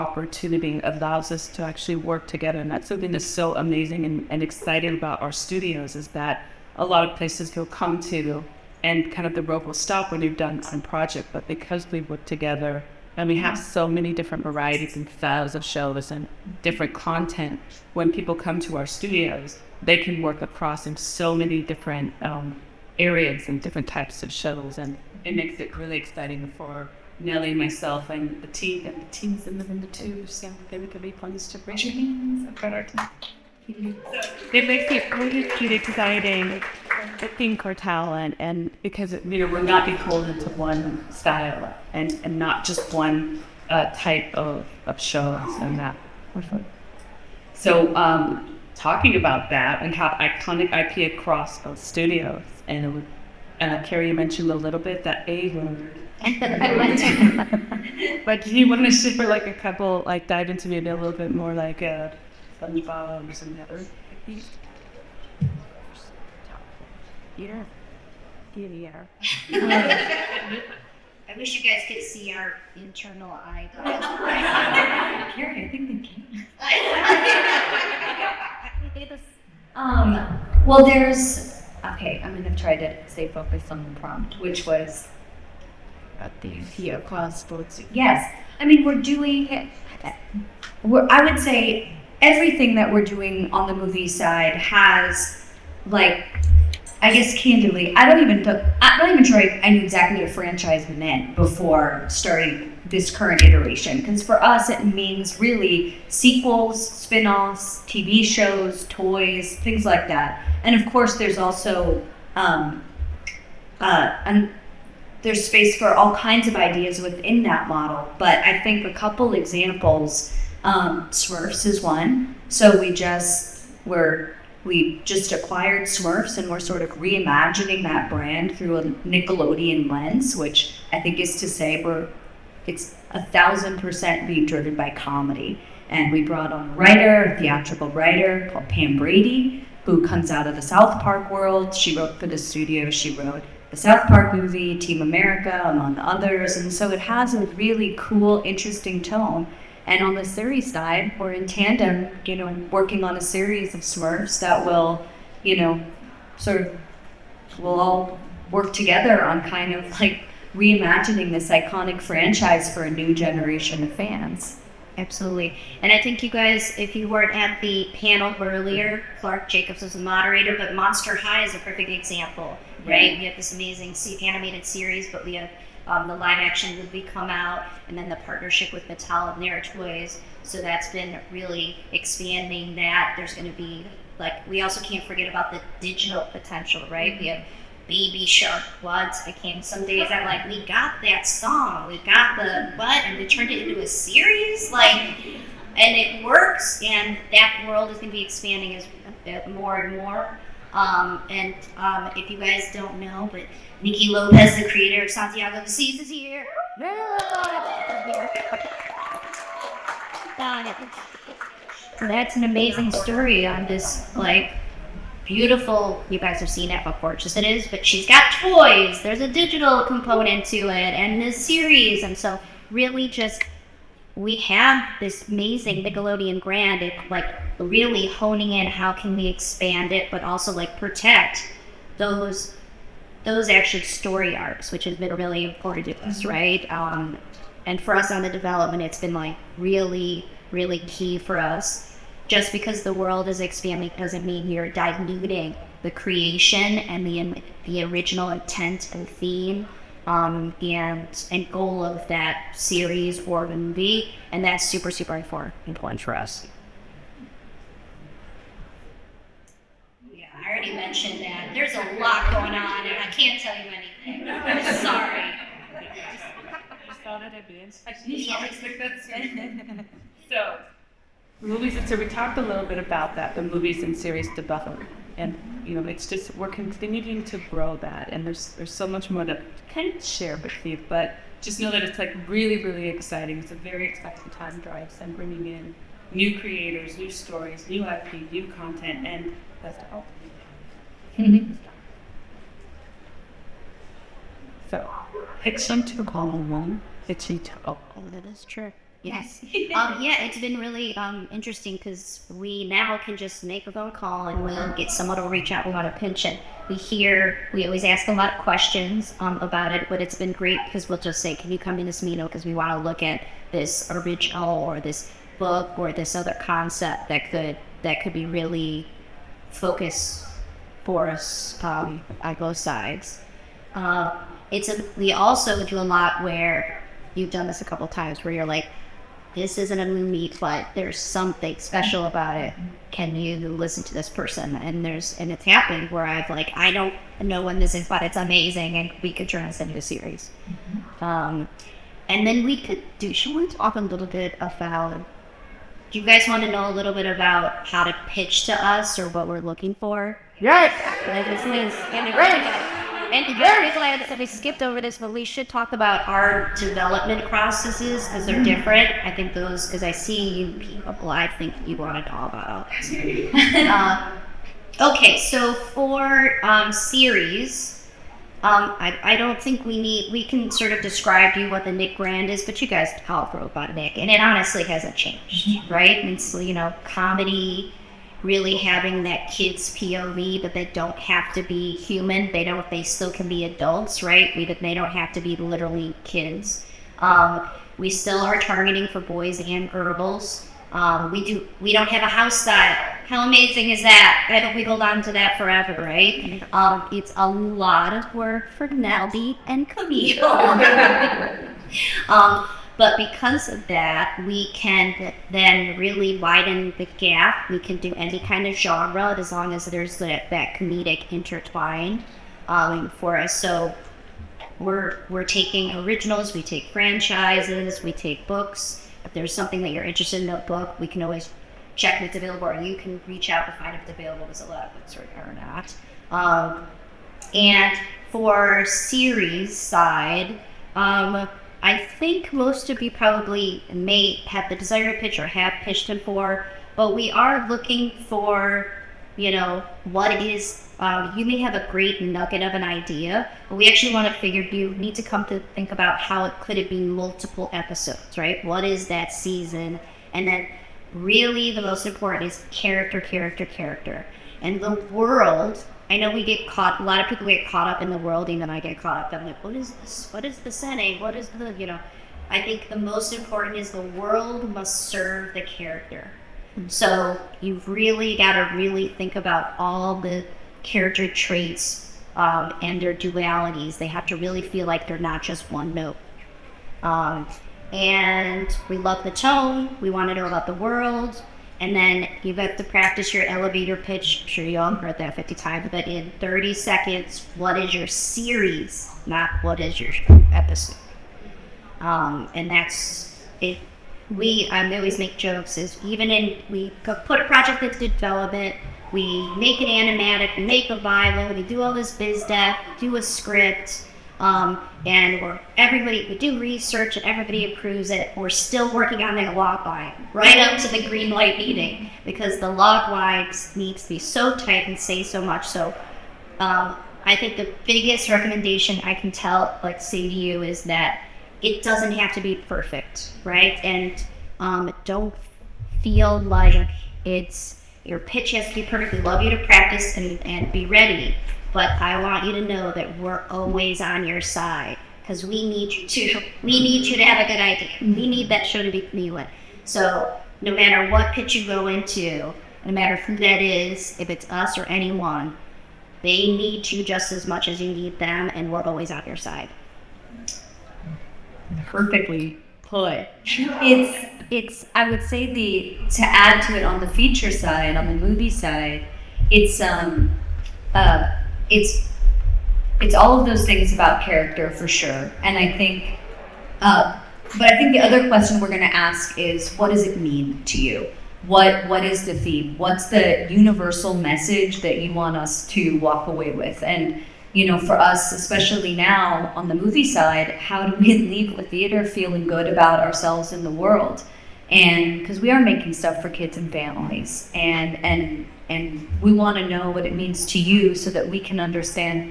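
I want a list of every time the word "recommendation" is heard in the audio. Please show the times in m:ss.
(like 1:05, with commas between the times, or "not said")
8:38.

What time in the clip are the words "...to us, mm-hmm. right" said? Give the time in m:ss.
3:55.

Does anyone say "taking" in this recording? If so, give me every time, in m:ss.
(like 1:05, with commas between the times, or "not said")
6:55.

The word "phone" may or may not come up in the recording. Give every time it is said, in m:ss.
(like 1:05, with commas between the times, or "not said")
5:03.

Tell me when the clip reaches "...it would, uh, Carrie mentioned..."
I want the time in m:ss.
0:52.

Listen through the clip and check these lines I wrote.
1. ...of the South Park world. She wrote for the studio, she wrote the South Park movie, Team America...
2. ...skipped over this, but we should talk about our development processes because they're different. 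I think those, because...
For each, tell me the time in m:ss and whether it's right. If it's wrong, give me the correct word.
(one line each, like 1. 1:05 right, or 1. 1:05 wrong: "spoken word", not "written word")
1. 2:20 right
2. 5:54 right.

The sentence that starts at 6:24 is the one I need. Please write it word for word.
We, they don't have to be literally kids.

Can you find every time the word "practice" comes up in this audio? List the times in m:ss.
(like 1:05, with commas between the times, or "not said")
8:02, 8:49.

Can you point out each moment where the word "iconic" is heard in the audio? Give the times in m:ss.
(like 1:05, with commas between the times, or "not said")
0:50, 2:41.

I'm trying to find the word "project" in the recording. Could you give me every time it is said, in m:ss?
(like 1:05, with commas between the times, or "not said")
0:10, 8:17.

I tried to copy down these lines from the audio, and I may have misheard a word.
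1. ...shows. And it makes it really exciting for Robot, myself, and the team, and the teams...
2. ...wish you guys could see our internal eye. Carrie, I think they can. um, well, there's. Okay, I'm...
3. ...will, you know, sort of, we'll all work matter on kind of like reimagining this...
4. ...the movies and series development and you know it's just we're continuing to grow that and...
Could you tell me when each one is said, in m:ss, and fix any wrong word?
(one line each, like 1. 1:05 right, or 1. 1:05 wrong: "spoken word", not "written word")
1. 0:24 wrong: "Nellie", not "Robot"
2. 1:11 right
3. 2:34 wrong: "together", not "matter"
4. 4:33 right.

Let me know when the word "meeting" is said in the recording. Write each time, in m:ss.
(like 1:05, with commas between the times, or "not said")
5:12, 8:31.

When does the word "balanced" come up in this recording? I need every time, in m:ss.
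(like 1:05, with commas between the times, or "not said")
not said.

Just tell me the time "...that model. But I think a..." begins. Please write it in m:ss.
1:57.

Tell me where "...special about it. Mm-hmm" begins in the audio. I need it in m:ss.
5:31.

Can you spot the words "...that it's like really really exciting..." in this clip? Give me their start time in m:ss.
4:41.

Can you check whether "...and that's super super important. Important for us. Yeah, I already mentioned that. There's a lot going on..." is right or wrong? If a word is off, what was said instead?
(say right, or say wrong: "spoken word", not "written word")
right.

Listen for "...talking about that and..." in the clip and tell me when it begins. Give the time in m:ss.
0:48.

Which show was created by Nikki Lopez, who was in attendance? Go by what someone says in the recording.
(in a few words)
Santiago of the Seas.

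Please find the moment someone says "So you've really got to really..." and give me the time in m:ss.
7:46.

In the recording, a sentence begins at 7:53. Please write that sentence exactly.
They have to really feel like they're not just one note.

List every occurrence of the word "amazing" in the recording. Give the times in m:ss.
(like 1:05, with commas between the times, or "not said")
0:03, 2:53, 3:32, 3:45, 5:38, 6:33.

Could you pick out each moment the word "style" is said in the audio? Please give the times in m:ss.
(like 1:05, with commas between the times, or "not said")
0:15, 0:41, 6:32.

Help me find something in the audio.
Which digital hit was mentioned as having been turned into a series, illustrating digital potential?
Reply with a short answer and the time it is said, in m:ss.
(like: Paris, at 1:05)
Baby Shark, at 3:07.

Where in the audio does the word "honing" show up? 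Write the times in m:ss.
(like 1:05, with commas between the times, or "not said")
3:48.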